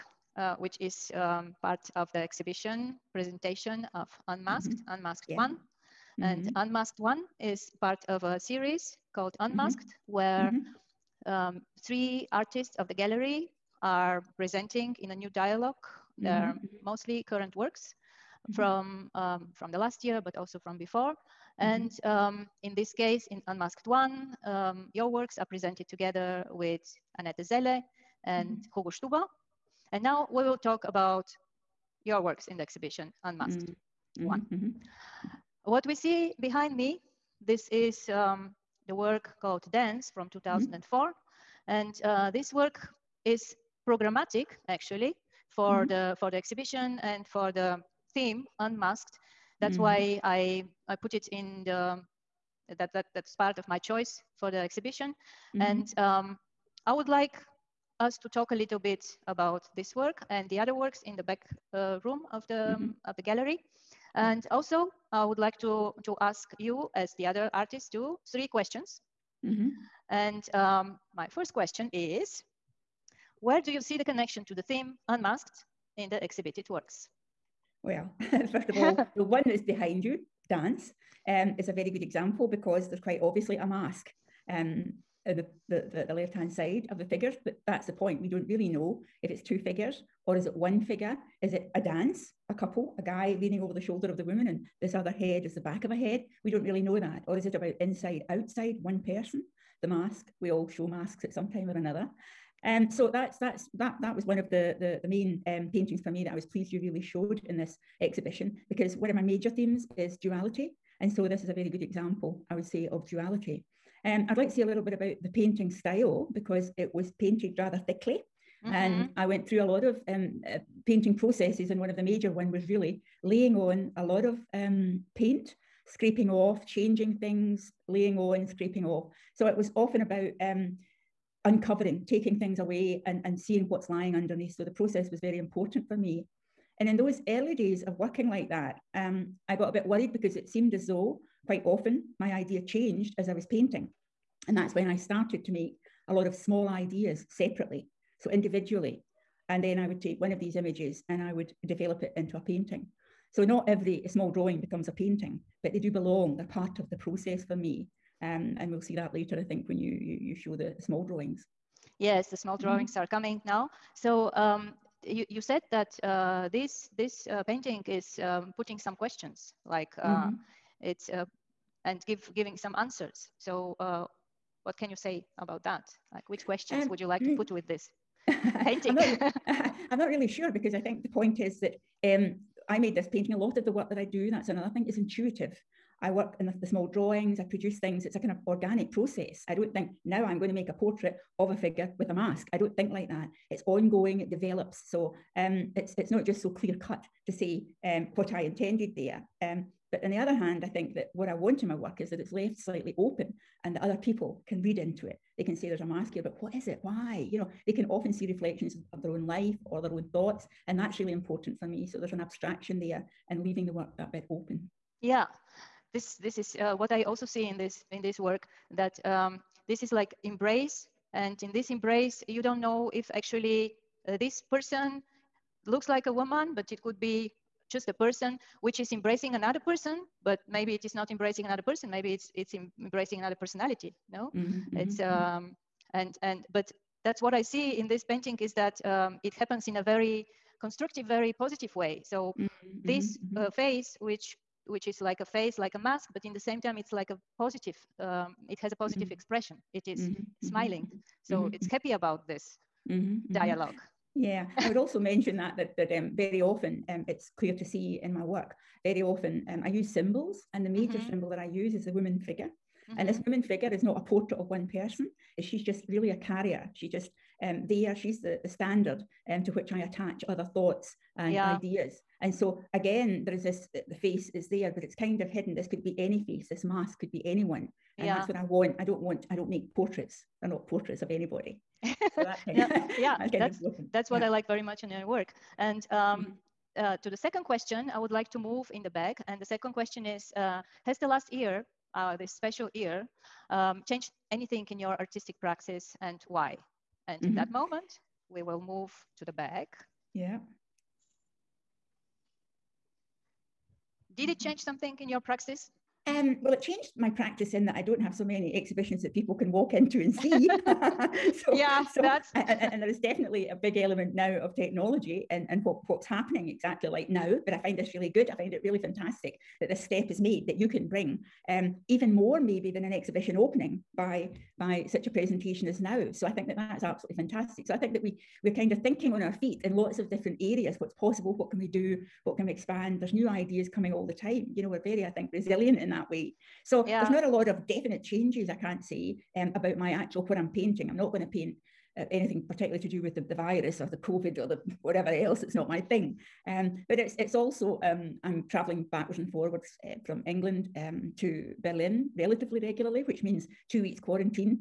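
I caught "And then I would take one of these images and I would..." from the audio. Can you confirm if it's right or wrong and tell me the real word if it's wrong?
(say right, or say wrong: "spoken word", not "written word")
right.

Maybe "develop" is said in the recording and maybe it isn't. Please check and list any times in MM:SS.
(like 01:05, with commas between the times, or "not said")
02:31, 03:14.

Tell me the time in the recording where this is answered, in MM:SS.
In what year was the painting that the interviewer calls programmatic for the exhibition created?
00:40.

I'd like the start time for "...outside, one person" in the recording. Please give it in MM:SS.
01:38.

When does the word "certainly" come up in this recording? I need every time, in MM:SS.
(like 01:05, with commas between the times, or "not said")
not said.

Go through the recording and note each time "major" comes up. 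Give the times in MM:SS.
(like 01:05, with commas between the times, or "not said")
01:49, 02:02, 04:20.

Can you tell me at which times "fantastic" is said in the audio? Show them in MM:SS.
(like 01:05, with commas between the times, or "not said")
05:18, 05:27.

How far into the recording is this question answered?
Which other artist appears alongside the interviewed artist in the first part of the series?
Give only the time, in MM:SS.
00:27.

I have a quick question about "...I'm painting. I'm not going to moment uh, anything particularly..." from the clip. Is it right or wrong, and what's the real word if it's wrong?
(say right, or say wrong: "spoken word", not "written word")
wrong: "paint", not "moment".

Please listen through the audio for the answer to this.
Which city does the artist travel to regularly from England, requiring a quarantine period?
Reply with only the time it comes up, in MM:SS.
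05:51.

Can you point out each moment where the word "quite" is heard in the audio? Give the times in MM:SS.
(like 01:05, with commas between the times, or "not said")
01:22, 02:21.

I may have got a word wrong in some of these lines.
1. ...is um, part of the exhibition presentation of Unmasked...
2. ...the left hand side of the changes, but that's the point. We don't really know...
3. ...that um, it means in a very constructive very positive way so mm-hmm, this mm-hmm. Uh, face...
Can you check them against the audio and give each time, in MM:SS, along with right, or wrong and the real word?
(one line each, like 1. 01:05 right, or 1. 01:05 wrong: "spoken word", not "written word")
1. 00:00 right
2. 01:26 wrong: "figures", not "changes"
3. 03:58 wrong: "happens", not "means".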